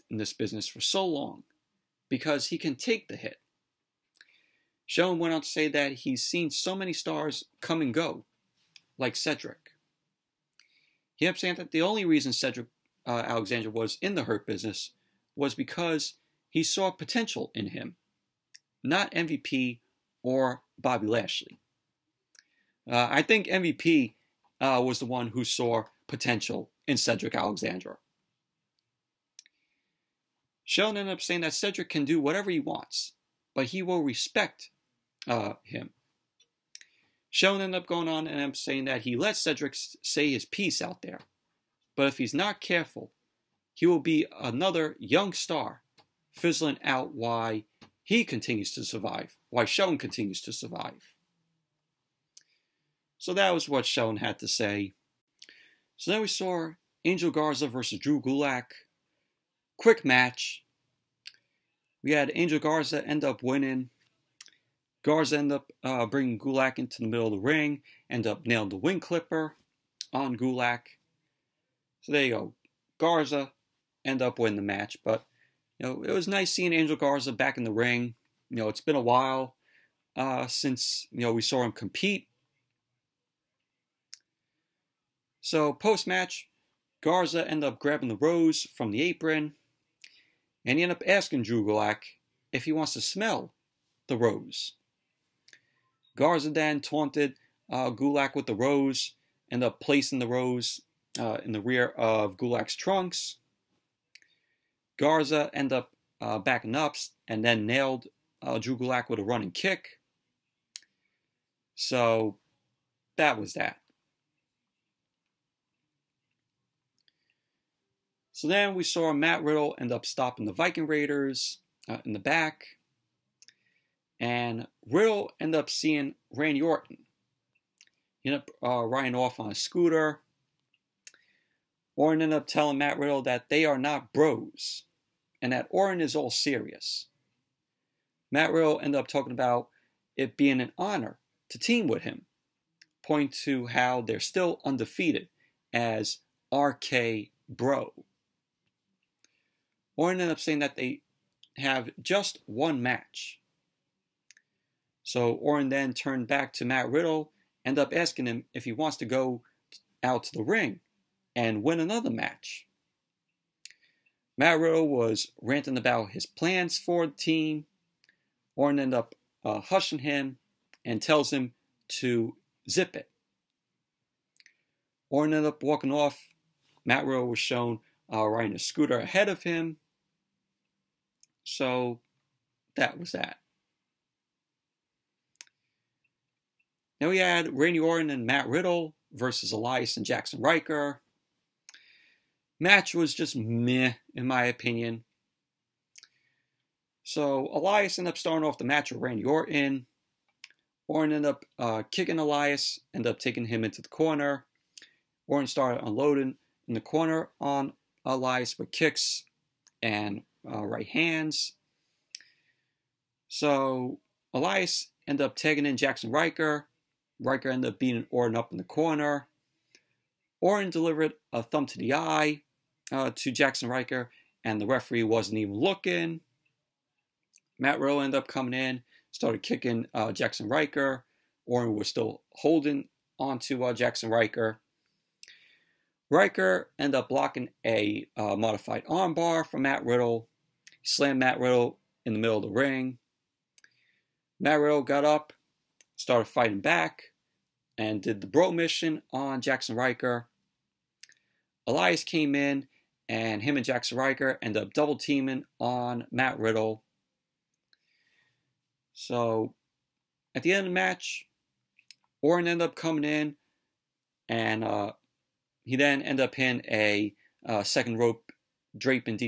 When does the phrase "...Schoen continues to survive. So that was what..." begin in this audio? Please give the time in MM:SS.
00:49.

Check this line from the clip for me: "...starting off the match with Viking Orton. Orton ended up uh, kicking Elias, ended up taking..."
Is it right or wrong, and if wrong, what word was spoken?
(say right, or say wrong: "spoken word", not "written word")
wrong: "Randy", not "Viking".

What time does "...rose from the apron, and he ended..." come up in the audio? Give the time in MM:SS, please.
01:28.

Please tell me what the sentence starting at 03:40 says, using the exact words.
Orton delivered a thumb to the eye uh, to Jaxson Ryker, and the referee wasn't even looking.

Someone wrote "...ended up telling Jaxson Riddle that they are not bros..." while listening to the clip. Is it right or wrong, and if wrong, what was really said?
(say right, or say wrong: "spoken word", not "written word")
wrong: "Matt", not "Jaxson".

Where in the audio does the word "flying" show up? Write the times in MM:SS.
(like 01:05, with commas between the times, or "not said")
not said.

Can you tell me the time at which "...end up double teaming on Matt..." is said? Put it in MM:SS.
04:14.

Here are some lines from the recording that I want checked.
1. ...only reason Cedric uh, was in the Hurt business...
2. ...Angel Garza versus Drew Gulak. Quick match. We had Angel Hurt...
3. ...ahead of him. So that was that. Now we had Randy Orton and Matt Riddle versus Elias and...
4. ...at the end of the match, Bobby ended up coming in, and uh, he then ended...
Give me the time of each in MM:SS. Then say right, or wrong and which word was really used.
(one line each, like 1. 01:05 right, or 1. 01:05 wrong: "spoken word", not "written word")
1. 00:11 right
2. 00:57 wrong: "Garza", not "Hurt"
3. 02:58 right
4. 04:20 wrong: "Orton", not "Bobby".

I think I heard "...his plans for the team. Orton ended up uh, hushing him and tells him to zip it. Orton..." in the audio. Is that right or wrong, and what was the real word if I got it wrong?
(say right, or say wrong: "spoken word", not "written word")
right.